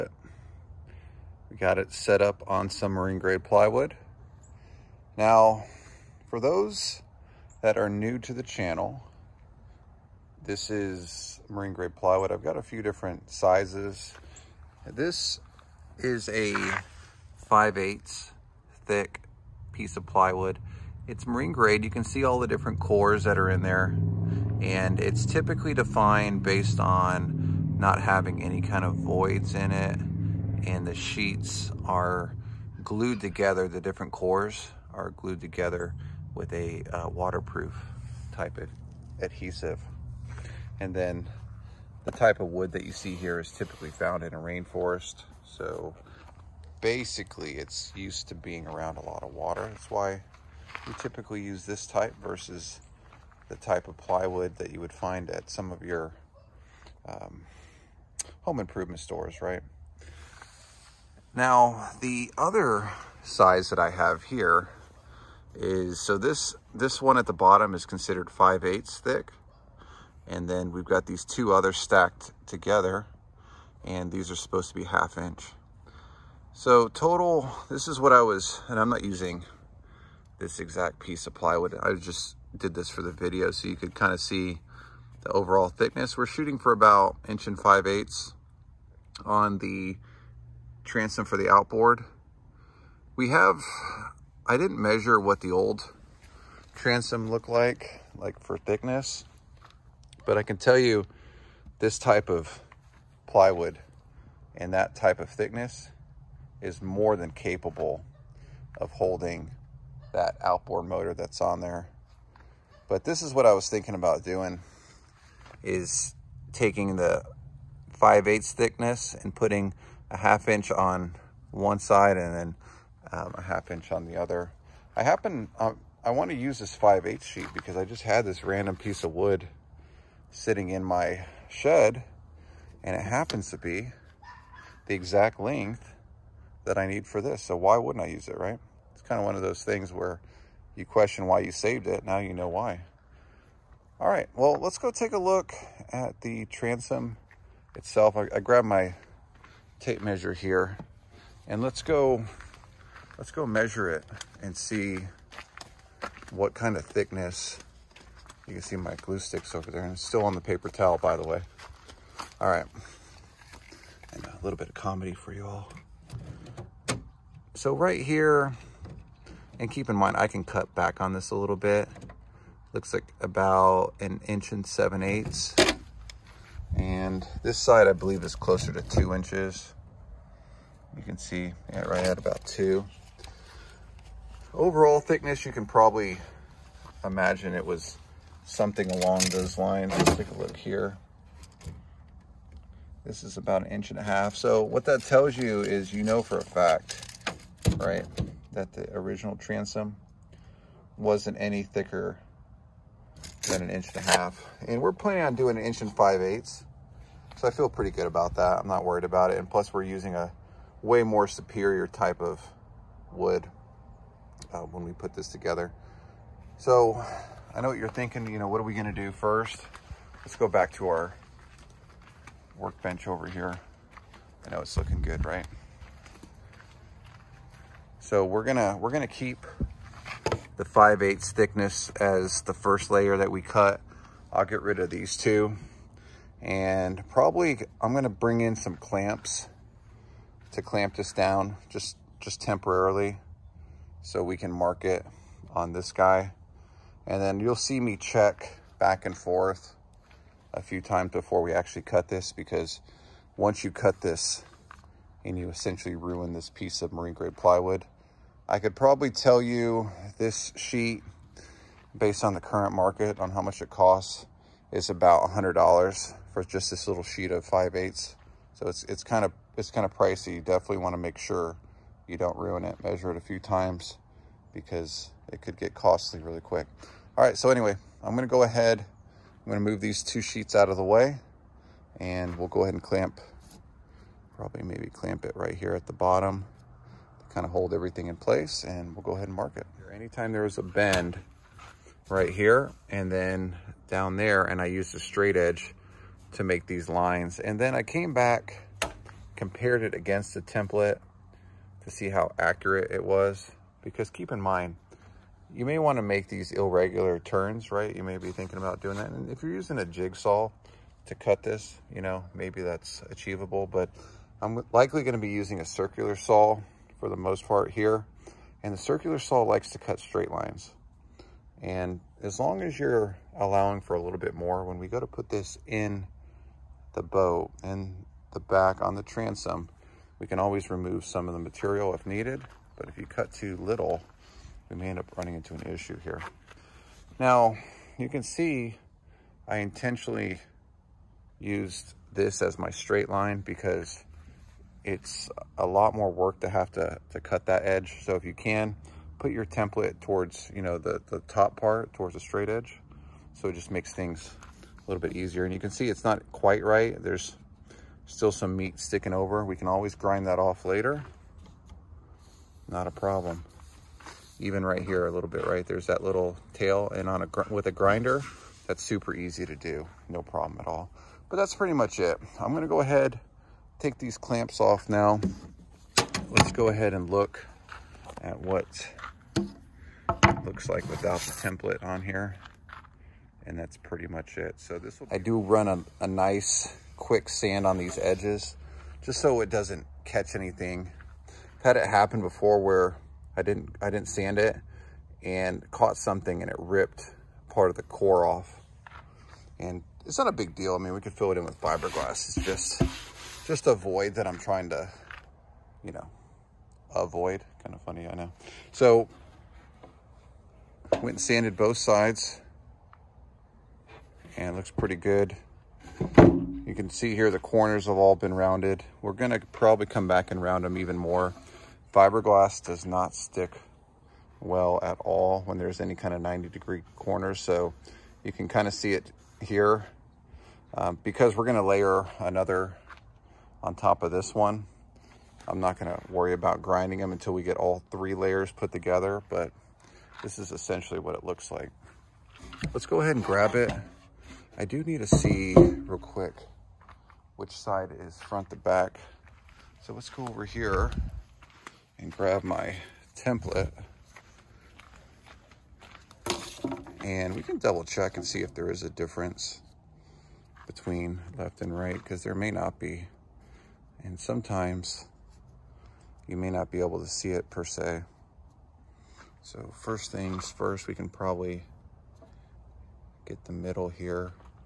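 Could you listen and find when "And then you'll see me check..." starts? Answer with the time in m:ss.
4:07.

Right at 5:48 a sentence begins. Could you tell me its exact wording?
So if you can, put your template towards, you know, the, the top part, towards the straight edge.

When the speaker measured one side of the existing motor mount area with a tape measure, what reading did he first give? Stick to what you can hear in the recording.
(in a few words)
1 7/8 inch.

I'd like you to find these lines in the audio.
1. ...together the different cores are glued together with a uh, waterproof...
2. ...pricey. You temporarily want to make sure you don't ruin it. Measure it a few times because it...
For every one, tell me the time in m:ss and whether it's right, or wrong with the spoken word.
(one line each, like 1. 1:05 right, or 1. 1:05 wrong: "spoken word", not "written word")
1. 0:33 right
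2. 4:29 wrong: "definitely", not "temporarily".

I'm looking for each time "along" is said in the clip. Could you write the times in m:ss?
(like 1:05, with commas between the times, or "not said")
3:08.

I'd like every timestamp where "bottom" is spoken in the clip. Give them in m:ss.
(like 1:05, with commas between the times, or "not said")
1:07, 4:45.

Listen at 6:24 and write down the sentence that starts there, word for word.
So this will I do run a, a nice quick sand on these edges just so it doesn't catch anything.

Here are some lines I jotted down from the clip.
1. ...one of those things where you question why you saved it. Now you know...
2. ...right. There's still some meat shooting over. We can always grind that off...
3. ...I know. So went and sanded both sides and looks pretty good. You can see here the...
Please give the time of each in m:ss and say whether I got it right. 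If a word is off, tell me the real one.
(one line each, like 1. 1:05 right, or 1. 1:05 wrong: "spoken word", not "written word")
1. 2:19 right
2. 5:56 wrong: "sticking", not "shooting"
3. 6:48 right.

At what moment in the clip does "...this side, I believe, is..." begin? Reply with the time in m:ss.
2:57.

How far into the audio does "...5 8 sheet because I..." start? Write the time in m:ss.
2:06.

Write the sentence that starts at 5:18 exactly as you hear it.
And the circular saw likes to cut straight lines.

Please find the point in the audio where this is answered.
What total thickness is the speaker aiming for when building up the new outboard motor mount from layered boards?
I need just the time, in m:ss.
1:27.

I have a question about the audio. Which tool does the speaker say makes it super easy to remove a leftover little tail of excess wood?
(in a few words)
Grinder.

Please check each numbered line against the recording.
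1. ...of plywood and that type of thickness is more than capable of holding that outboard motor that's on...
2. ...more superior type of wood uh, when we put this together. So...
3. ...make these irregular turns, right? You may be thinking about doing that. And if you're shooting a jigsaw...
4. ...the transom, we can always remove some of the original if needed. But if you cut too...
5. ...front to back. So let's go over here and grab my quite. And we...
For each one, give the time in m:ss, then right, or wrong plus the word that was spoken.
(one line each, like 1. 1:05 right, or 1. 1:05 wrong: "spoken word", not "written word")
1. 1:42 right
2. 3:31 right
3. 5:06 wrong: "using", not "shooting"
4. 5:28 wrong: "material", not "original"
5. 7:28 wrong: "template", not "quite".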